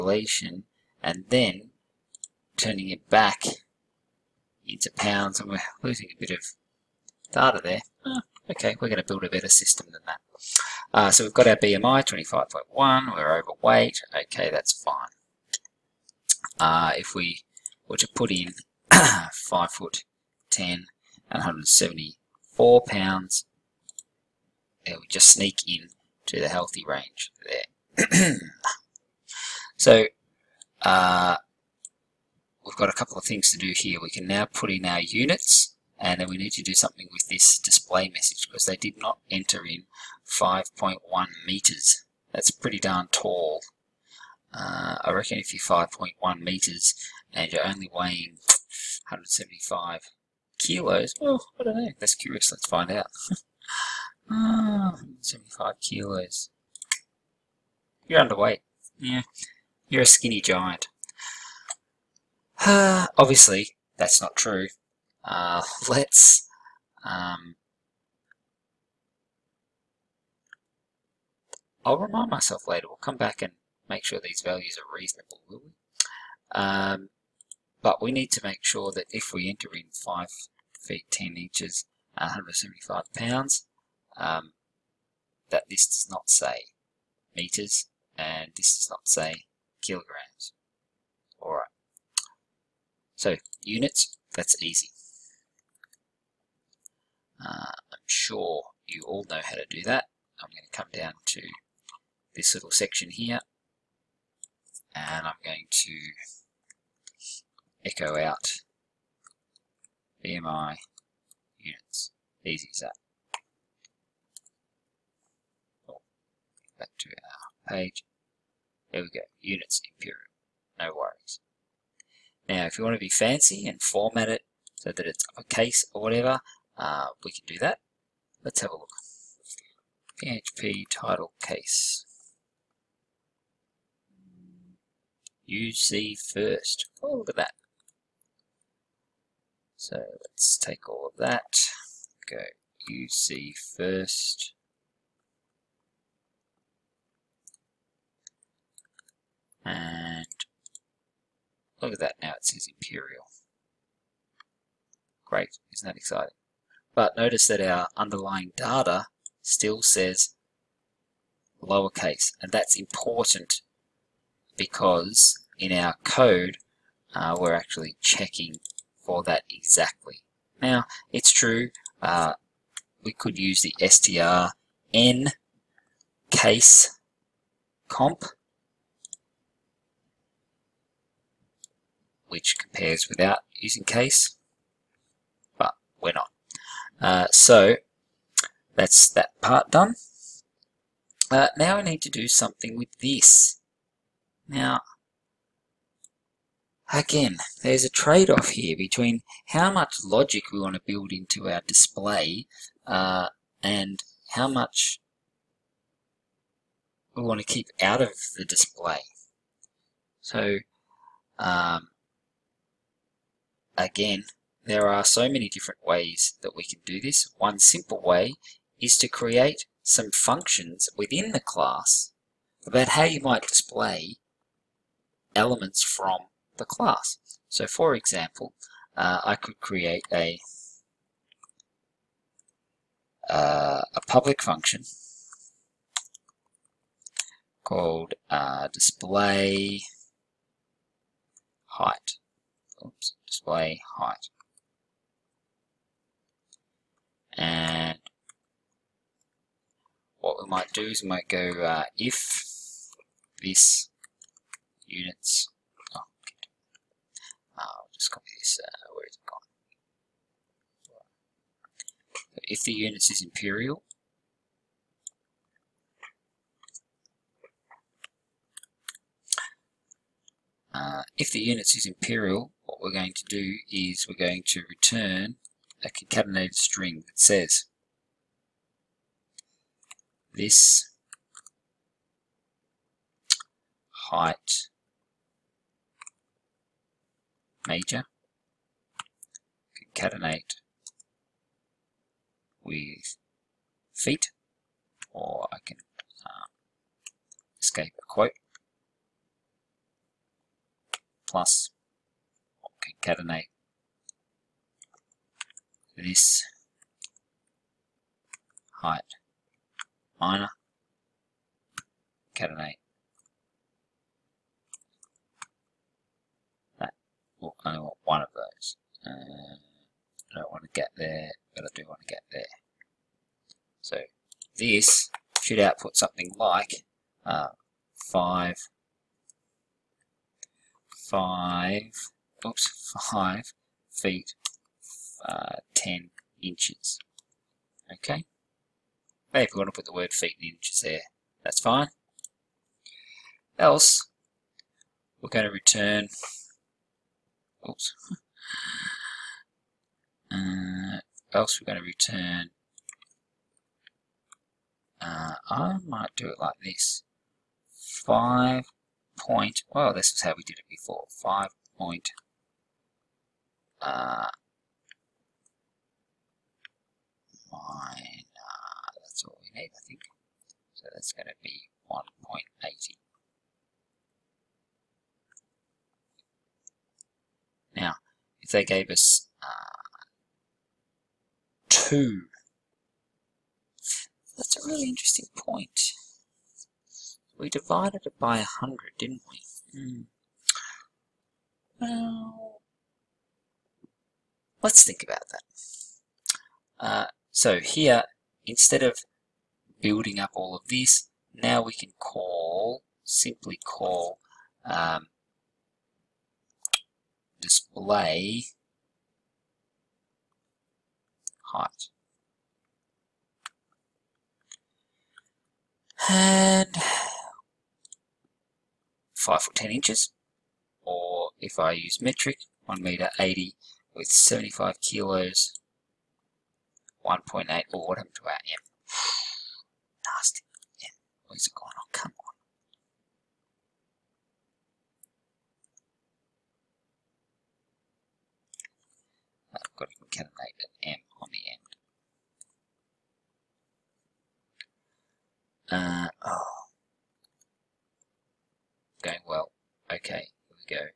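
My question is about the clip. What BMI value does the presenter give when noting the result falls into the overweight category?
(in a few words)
25.1.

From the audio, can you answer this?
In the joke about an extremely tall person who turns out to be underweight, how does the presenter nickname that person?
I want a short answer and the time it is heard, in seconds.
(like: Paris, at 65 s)
skinny giant, at 60 s.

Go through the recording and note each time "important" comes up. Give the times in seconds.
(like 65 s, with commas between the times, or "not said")
162 s.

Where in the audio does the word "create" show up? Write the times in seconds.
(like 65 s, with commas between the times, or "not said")
219 s, 229 s.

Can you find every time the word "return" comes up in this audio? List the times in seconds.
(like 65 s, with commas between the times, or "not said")
274 s, 345 s, 351 s.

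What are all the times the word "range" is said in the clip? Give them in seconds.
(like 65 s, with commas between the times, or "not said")
26 s.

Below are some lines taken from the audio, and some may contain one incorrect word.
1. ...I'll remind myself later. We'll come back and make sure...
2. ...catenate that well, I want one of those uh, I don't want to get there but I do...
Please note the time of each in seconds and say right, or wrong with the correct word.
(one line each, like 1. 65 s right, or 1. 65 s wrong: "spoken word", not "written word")
1. 71 s right
2. 312 s right.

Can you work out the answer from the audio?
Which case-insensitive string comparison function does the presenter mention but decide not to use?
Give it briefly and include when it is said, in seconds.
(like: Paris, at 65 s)
str n case comp, at 173 s.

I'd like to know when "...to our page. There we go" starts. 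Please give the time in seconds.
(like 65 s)
116 s.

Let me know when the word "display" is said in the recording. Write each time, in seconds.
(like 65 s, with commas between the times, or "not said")
37 s, 201 s, 208 s, 223 s, 238 s, 243 s, 407 s.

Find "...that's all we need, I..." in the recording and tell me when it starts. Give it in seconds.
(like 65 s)
369 s.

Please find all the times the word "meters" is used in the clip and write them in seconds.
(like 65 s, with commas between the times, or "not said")
41 s, 46 s, 87 s, 422 s.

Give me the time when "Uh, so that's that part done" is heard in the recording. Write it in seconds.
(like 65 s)
186 s.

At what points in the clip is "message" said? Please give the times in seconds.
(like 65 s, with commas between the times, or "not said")
38 s.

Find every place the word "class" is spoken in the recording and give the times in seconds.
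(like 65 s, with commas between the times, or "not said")
221 s, 226 s.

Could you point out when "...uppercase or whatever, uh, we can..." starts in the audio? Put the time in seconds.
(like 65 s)
125 s.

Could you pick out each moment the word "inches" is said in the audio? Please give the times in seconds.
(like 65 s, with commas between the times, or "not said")
81 s, 336 s, 340 s, 419 s.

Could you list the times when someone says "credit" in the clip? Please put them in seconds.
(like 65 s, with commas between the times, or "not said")
not said.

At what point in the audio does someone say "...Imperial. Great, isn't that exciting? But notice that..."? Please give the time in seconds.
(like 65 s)
152 s.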